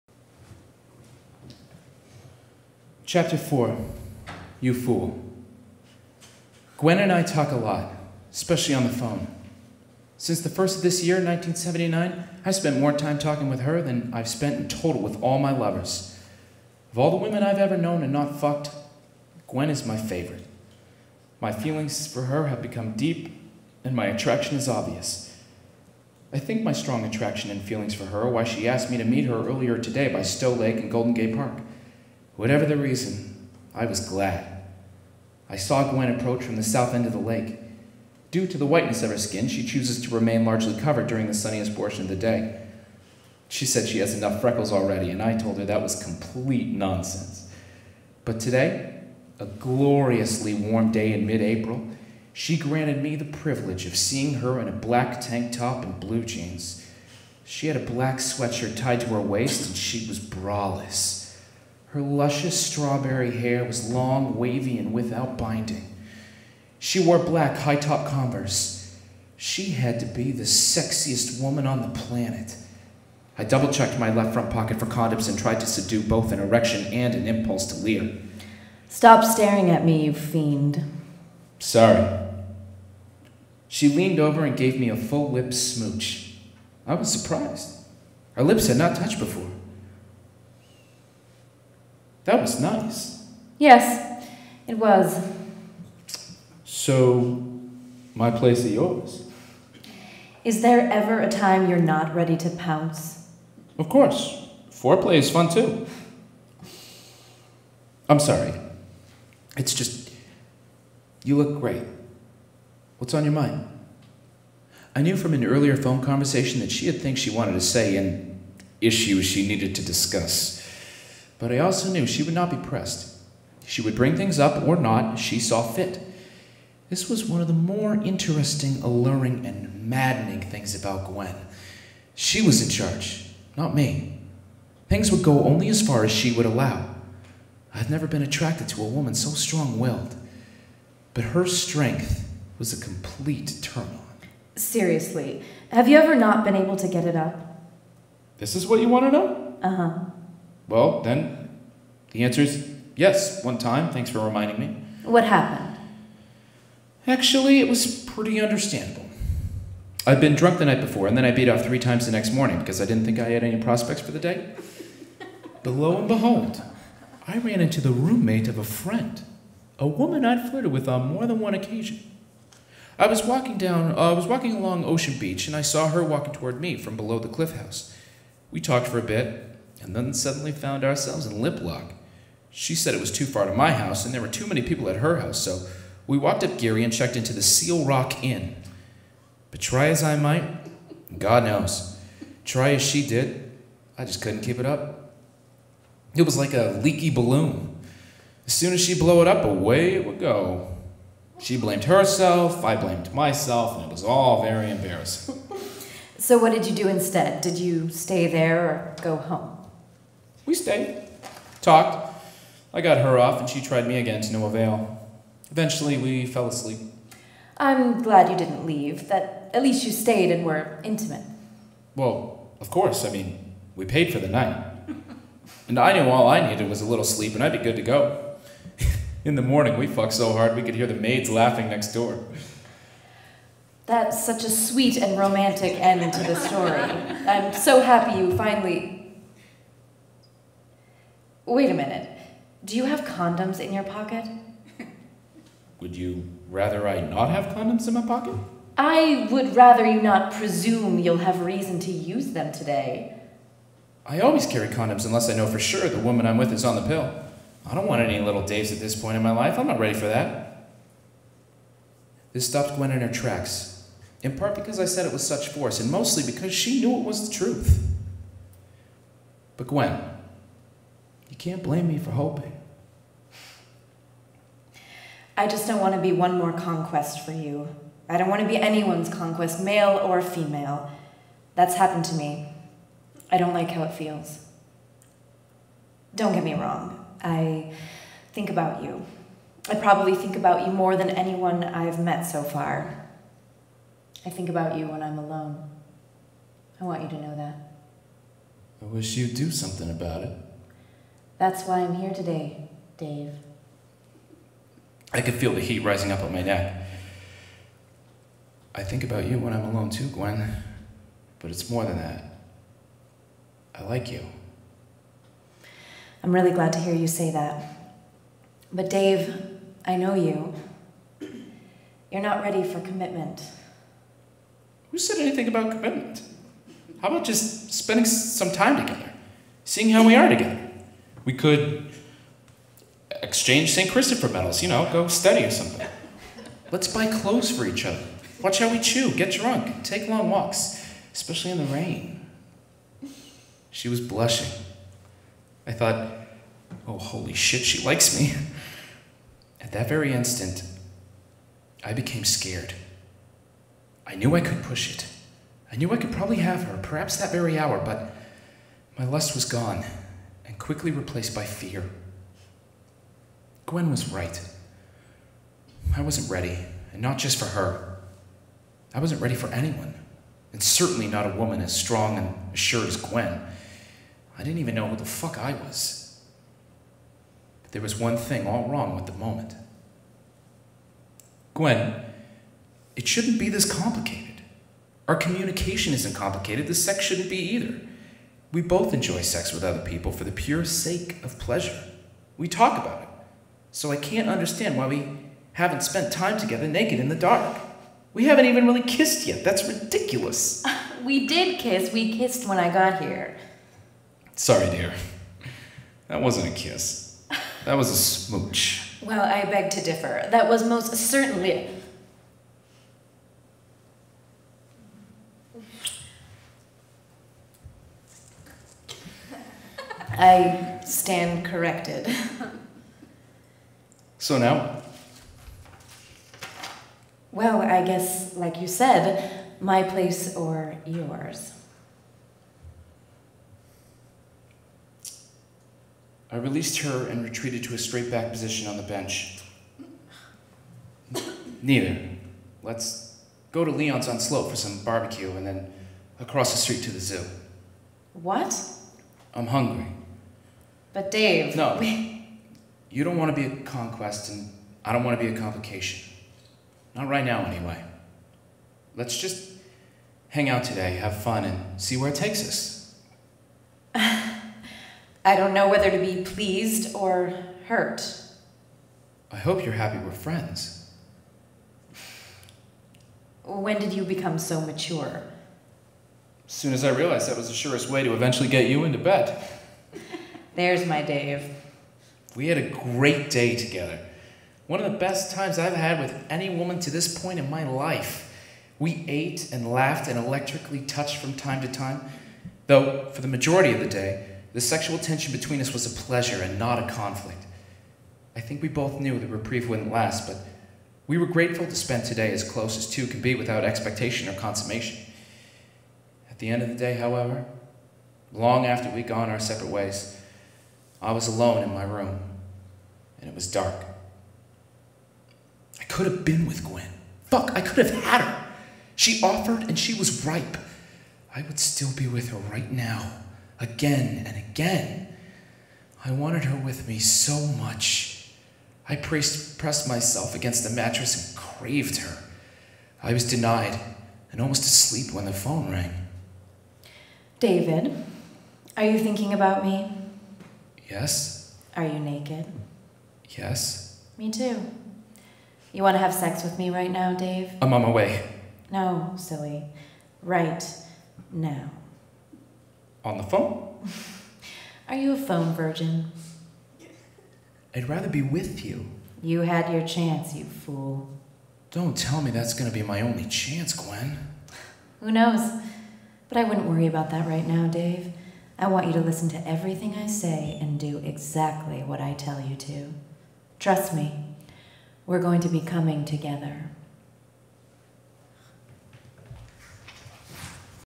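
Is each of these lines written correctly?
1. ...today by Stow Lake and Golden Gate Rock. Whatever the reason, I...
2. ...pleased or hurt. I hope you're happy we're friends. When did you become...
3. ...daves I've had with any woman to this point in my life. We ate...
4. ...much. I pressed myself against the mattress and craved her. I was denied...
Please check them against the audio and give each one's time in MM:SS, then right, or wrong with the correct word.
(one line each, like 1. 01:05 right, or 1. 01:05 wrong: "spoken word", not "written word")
1. 00:29 wrong: "Park", not "Rock"
2. 07:46 right
3. 08:05 wrong: "times", not "daves"
4. 08:47 right.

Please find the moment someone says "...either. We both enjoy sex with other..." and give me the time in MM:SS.
06:27.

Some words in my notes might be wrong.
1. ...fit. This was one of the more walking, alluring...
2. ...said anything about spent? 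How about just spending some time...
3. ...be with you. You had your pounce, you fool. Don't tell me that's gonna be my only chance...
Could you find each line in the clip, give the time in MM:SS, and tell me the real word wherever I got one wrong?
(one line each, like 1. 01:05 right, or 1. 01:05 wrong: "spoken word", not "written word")
1. 02:05 wrong: "interesting", not "walking"
2. 05:24 wrong: "commitment", not "spent"
3. 09:18 wrong: "chance", not "pounce".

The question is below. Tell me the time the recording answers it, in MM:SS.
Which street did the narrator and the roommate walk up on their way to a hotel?
03:06.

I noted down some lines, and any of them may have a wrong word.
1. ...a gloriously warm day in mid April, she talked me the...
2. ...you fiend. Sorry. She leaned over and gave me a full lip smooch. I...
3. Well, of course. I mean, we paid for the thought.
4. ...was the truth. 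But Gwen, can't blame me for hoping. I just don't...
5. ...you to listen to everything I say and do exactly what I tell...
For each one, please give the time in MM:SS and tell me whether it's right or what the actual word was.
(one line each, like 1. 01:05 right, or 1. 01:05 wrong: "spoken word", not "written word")
1. 00:49 wrong: "granted", not "talked"
2. 01:20 right
3. 03:41 wrong: "night", not "thought"
4. 04:27 right
5. 09:28 right.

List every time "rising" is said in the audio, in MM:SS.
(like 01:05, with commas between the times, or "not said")
05:05.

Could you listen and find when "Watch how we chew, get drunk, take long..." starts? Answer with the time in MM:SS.
05:38.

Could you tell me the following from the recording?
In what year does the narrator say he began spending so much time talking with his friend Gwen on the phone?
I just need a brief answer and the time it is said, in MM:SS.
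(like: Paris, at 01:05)
1979, at 00:11.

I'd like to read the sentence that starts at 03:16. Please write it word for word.
It was like a leaky balloon.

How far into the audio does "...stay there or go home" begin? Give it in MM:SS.
03:27.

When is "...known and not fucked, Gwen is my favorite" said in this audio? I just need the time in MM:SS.
00:17.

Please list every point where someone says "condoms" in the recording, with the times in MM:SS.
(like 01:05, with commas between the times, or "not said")
01:14, 04:03, 04:07, 04:14.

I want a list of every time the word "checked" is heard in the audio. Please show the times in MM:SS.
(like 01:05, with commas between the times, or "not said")
01:13, 03:06.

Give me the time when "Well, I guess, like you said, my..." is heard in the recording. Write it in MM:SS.
07:07.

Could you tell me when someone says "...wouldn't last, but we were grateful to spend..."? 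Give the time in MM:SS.
08:19.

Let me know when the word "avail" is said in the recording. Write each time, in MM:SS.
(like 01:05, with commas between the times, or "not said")
03:34.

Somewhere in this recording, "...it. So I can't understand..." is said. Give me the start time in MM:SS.
06:33.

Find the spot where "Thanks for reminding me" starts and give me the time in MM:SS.
02:33.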